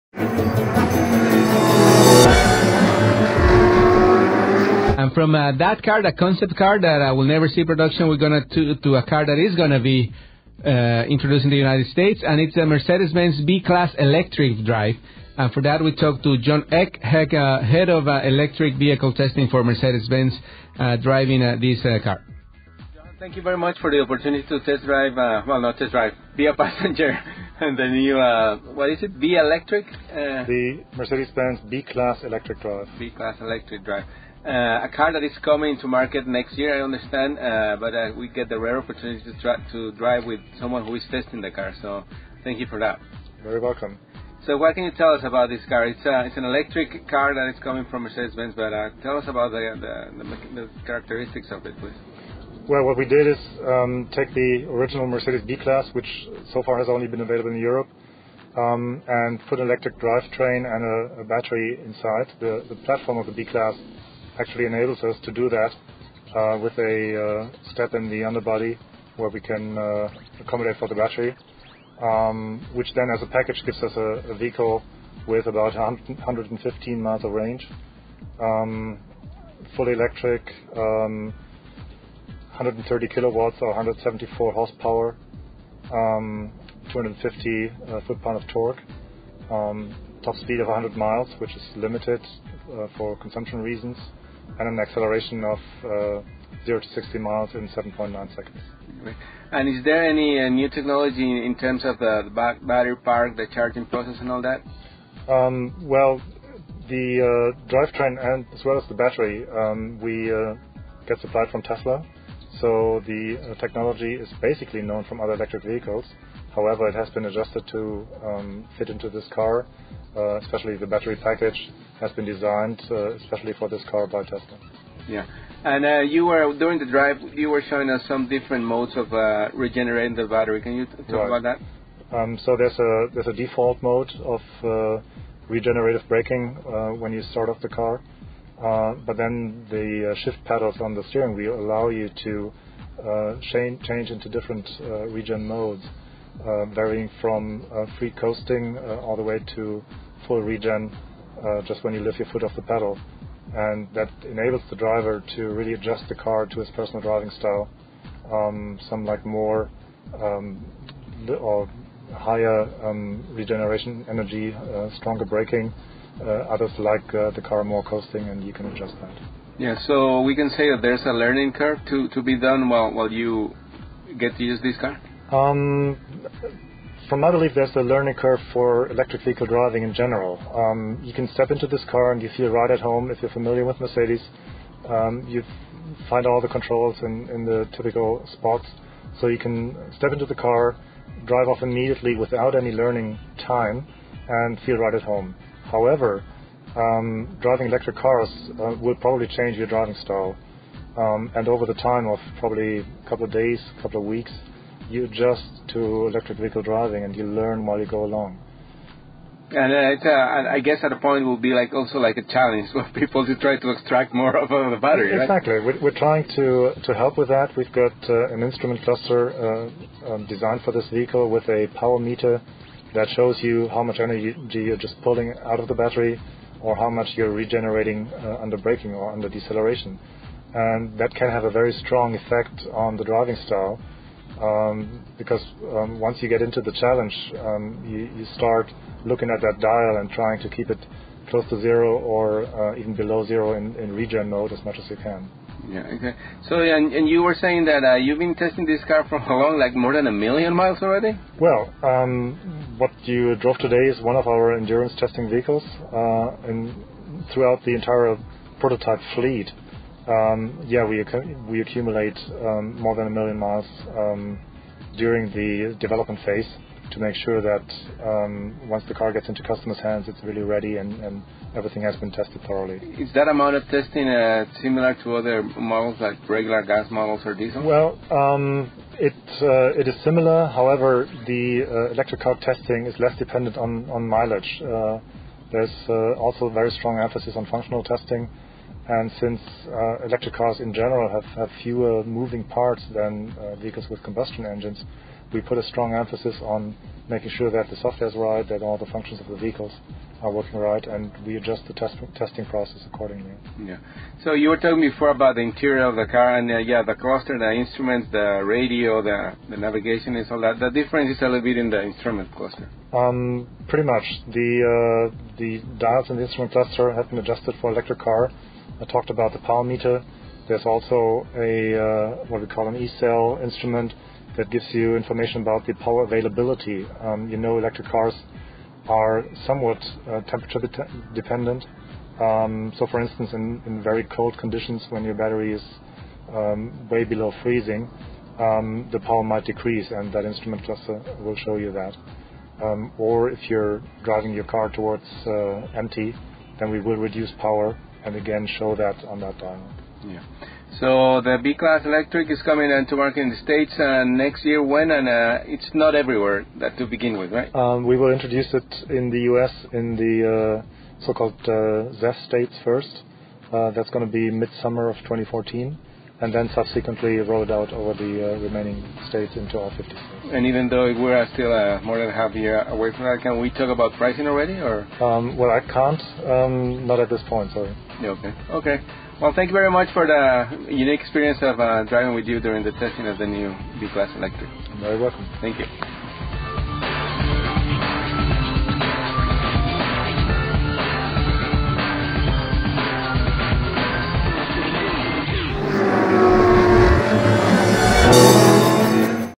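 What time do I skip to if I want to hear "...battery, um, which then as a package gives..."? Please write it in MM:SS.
01:10.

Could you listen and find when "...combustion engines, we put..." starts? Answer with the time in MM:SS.
04:54.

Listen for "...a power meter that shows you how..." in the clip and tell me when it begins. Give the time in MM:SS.
03:41.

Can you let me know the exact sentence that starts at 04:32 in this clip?
Is that amount of testing uh, similar to other models like regular gas models or diesel?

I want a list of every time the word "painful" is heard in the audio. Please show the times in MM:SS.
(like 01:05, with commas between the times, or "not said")
not said.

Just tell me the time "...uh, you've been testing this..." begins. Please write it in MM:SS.
04:07.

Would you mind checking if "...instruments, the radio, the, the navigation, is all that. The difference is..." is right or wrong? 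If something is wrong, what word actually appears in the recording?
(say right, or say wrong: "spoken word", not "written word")
right.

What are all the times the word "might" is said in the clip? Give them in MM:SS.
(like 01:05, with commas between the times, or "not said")
05:39.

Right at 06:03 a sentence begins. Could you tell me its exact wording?
Uh, that's going to be midsummer of 2014.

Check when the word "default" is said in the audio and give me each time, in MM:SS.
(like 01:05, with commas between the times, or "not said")
02:13.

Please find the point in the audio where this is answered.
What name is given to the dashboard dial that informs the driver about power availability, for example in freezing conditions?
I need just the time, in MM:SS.
05:22.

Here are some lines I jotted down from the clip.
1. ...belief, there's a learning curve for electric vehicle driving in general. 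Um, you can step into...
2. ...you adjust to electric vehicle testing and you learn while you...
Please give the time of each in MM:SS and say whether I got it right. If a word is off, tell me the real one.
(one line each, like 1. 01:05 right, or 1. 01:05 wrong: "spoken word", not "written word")
1. 02:57 right
2. 03:24 wrong: "driving", not "testing".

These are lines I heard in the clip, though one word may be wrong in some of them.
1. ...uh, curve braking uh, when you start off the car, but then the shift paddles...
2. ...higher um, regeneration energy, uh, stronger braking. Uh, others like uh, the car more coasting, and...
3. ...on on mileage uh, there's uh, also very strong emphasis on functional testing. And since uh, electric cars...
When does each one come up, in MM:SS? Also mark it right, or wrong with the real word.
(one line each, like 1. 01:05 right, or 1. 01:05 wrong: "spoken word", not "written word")
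1. 02:14 wrong: "regenerative", not "curve"
2. 02:42 right
3. 04:43 right.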